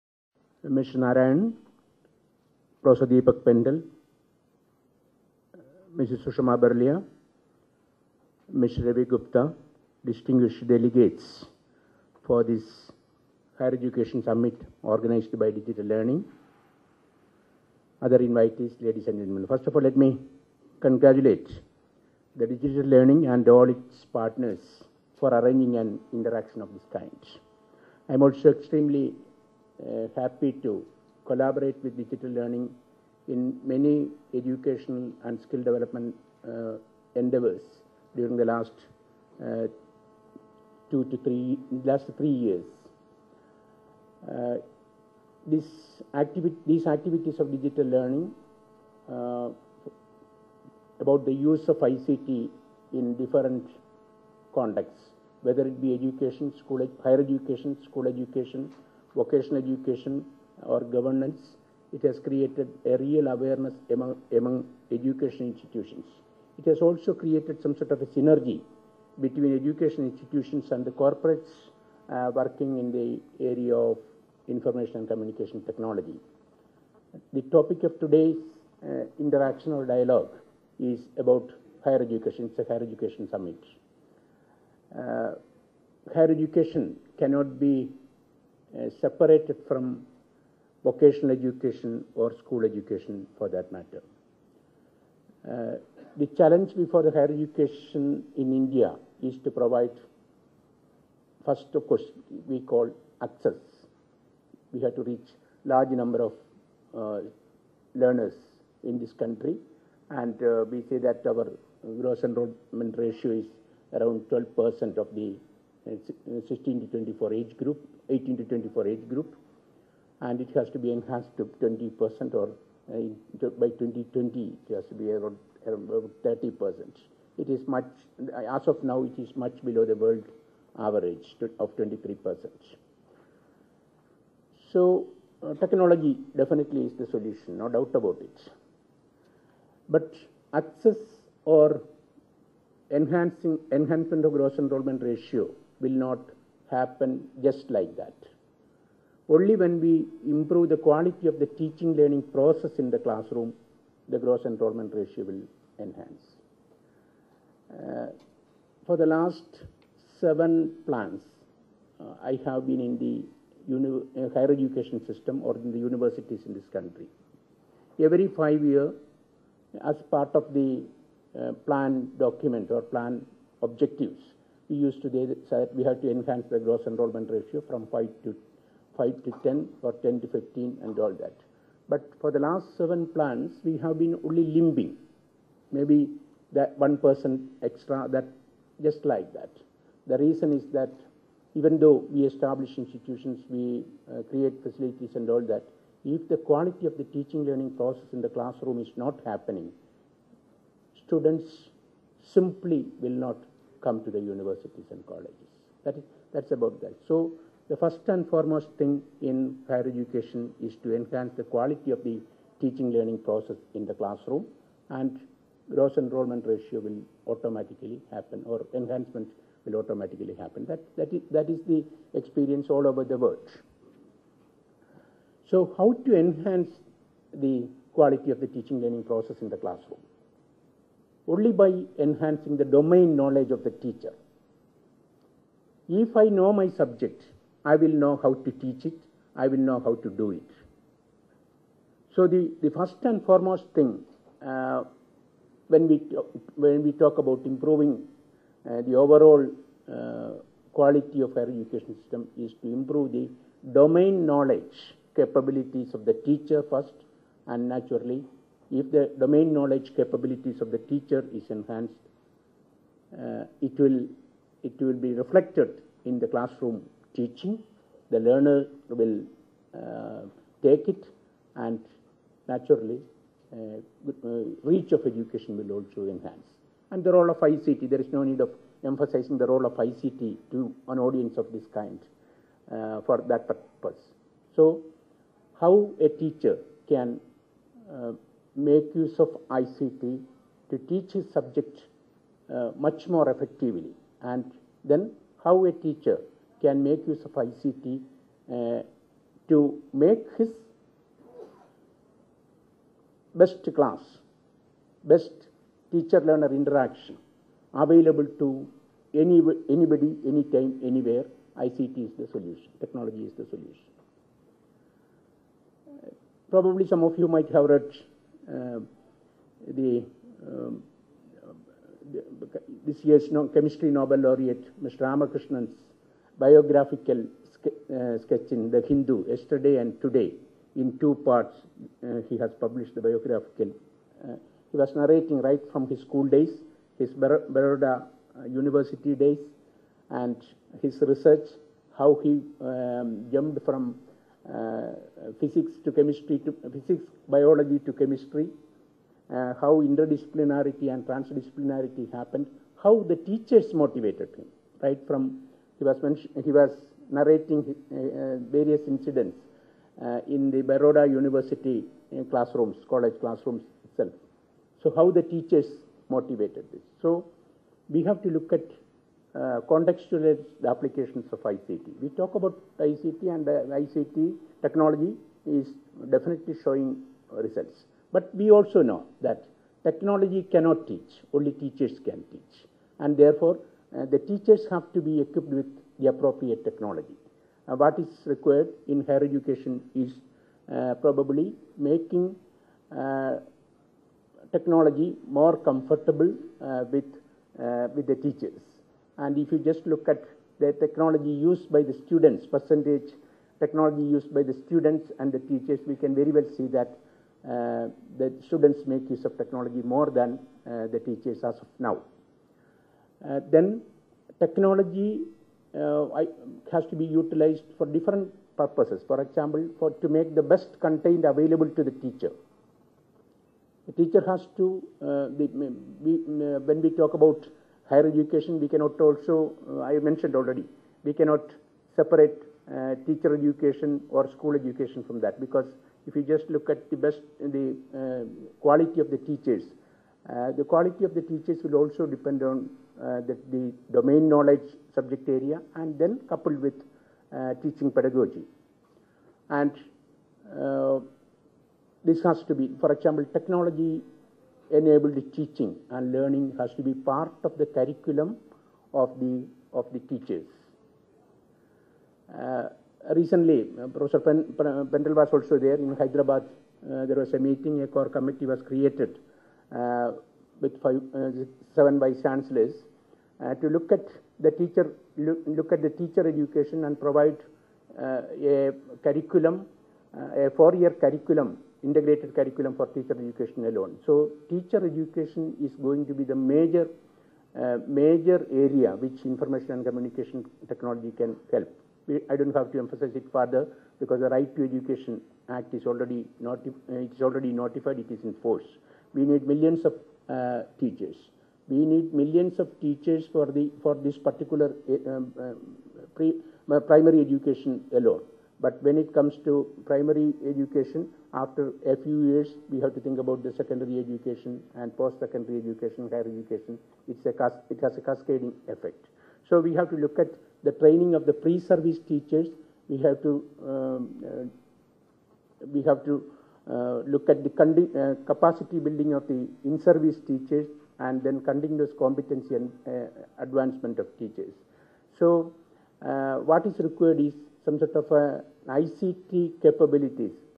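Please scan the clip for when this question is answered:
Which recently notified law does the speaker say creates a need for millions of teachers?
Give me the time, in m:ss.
8:14.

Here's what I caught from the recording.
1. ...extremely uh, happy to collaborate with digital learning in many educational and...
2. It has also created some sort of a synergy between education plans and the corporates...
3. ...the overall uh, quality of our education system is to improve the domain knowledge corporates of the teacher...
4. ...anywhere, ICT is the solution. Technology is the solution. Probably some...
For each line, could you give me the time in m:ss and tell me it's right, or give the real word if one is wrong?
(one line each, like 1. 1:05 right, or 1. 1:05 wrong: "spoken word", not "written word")
1. 0:28 right
2. 1:06 wrong: "institutions", not "plans"
3. 4:08 wrong: "capabilities", not "corporates"
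4. 5:10 right.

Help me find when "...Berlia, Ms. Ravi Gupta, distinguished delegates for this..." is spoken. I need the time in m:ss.
0:06.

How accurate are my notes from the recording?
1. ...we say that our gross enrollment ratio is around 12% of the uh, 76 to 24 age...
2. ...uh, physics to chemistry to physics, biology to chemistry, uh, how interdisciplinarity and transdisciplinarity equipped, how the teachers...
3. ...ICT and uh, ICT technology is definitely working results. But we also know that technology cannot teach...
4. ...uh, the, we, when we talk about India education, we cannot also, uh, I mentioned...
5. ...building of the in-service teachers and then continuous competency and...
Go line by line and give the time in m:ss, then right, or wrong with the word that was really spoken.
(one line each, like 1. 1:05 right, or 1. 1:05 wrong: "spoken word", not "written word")
1. 1:50 wrong: "16", not "76"
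2. 5:44 wrong: "happened", not "equipped"
3. 6:12 wrong: "showing", not "working"
4. 7:05 wrong: "Higher", not "India"
5. 8:48 right.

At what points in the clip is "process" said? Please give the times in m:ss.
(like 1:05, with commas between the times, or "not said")
2:32, 3:17, 3:33, 3:49.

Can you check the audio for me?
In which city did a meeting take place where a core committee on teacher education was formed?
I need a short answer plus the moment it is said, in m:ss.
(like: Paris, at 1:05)
Hyderabad, at 7:45.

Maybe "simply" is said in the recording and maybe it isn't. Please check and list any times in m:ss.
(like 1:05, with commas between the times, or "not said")
3:22.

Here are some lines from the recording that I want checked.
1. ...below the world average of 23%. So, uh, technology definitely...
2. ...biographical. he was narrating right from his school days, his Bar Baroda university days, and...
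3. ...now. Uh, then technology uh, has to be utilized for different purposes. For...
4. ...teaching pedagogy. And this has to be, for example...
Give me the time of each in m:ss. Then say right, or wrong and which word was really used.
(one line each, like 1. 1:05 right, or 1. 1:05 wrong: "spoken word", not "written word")
1. 2:09 right
2. 5:33 right
3. 6:51 right
4. 7:27 right.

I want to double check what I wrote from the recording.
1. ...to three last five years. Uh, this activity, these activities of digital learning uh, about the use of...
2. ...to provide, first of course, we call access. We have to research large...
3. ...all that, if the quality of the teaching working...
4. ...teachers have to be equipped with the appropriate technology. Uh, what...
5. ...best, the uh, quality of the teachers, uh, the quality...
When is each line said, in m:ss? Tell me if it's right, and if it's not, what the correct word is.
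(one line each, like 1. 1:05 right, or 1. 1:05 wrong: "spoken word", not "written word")
1. 0:41 wrong: "three", not "five"
2. 1:39 wrong: "reach", not "research"
3. 3:15 wrong: "learning", not "working"
4. 6:24 right
5. 7:16 right.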